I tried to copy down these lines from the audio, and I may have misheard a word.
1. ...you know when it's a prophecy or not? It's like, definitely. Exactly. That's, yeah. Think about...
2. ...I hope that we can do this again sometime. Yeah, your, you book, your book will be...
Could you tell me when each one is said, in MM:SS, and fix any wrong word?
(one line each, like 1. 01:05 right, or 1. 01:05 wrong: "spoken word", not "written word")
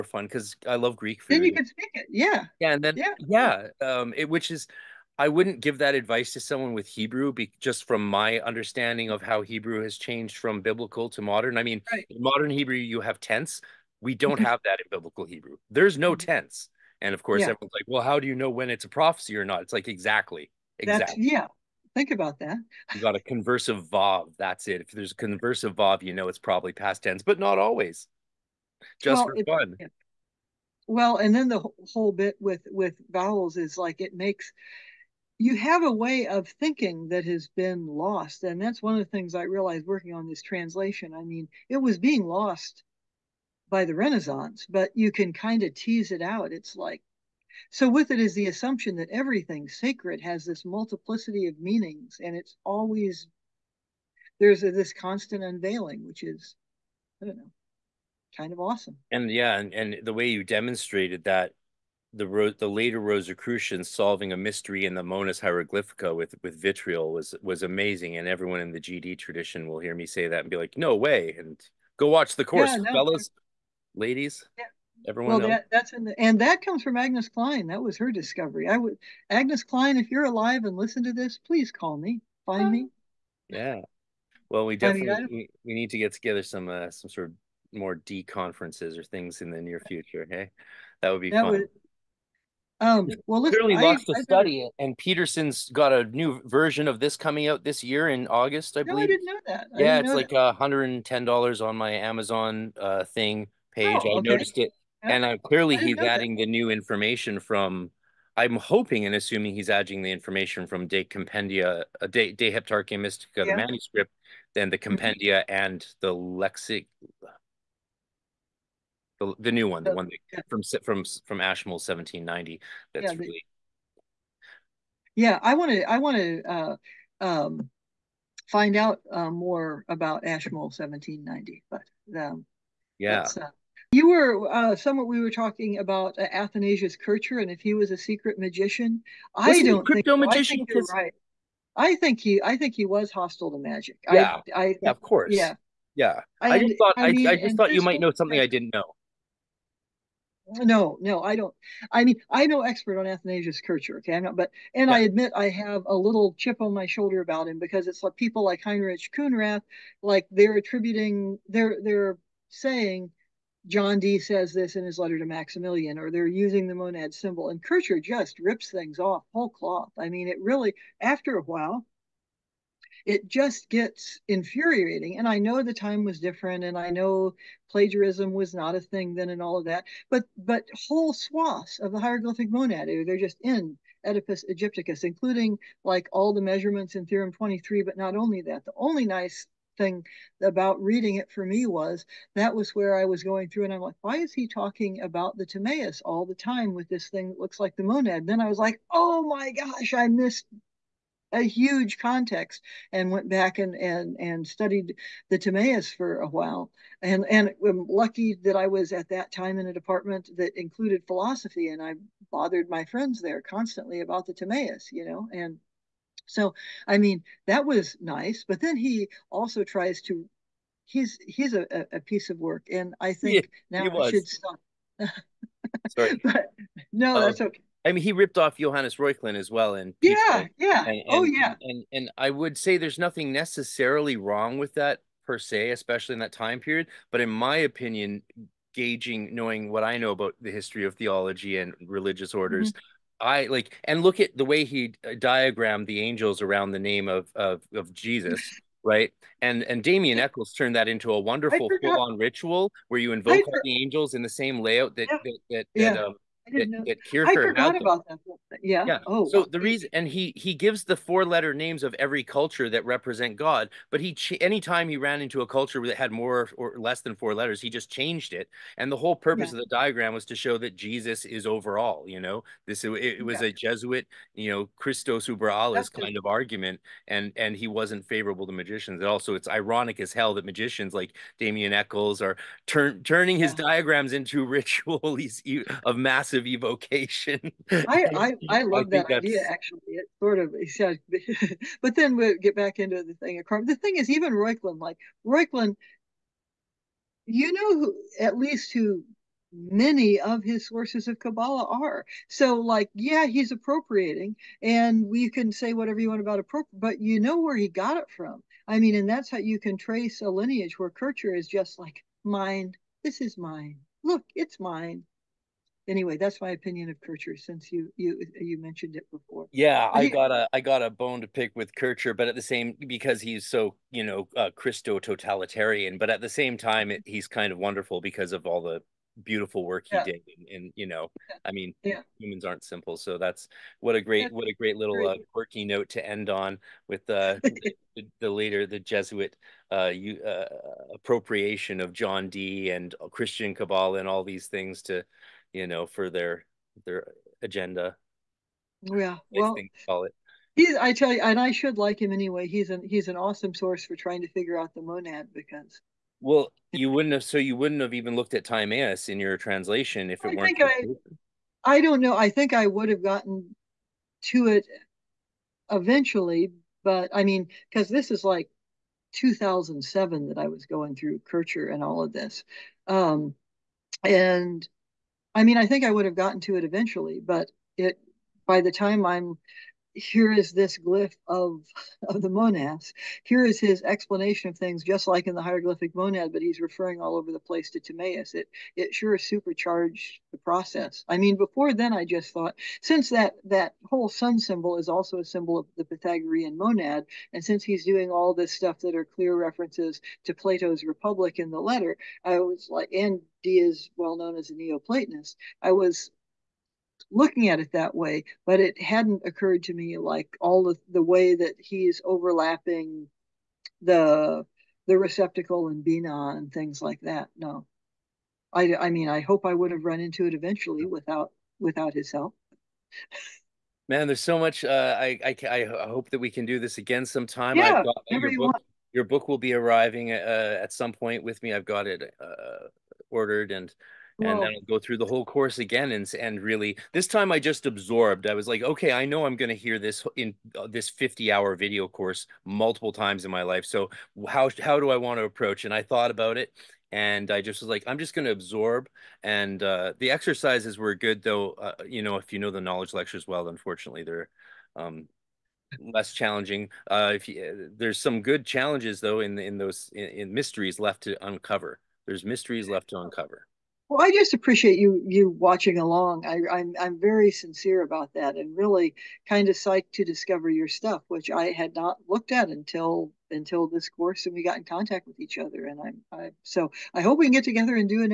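1. 00:18 wrong: "exactly", not "definitely"
2. 07:05 right.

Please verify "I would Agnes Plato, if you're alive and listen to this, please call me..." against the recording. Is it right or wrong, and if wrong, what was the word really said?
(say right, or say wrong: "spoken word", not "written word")
wrong: "Klein", not "Plato".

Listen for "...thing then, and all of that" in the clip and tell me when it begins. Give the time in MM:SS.
02:58.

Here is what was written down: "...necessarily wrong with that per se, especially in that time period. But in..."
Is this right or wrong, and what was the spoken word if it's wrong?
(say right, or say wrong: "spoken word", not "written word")
right.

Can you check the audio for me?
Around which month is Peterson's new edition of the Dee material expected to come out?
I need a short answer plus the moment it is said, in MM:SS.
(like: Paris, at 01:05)
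August, at 01:38.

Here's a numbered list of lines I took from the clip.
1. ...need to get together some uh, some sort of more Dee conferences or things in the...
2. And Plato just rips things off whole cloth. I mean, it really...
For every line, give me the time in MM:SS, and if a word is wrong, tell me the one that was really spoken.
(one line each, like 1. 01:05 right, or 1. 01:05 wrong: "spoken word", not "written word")
1. 01:25 right
2. 02:47 wrong: "Kircher", not "Plato".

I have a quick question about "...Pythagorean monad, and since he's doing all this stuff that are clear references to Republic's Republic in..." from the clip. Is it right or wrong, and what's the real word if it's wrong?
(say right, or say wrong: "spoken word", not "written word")
wrong: "Plato", not "Republic".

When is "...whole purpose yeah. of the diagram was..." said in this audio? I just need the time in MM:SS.
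04:28.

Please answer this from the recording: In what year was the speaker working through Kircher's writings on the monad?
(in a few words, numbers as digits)
2007.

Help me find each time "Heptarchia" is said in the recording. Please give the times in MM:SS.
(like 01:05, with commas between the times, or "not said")
01:52.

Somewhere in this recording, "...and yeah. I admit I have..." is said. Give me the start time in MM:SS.
02:34.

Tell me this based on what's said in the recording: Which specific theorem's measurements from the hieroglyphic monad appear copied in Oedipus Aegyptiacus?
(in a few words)
Theorem 23.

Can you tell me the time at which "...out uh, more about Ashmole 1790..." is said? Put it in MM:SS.
02:08.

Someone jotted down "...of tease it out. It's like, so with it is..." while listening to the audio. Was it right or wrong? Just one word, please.
right.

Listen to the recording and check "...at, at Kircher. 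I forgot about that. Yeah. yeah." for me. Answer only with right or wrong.
right.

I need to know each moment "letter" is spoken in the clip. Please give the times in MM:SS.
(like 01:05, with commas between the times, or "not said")
02:44, 04:21, 04:27, 06:41.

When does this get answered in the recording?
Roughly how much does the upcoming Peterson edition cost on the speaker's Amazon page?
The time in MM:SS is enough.
01:40.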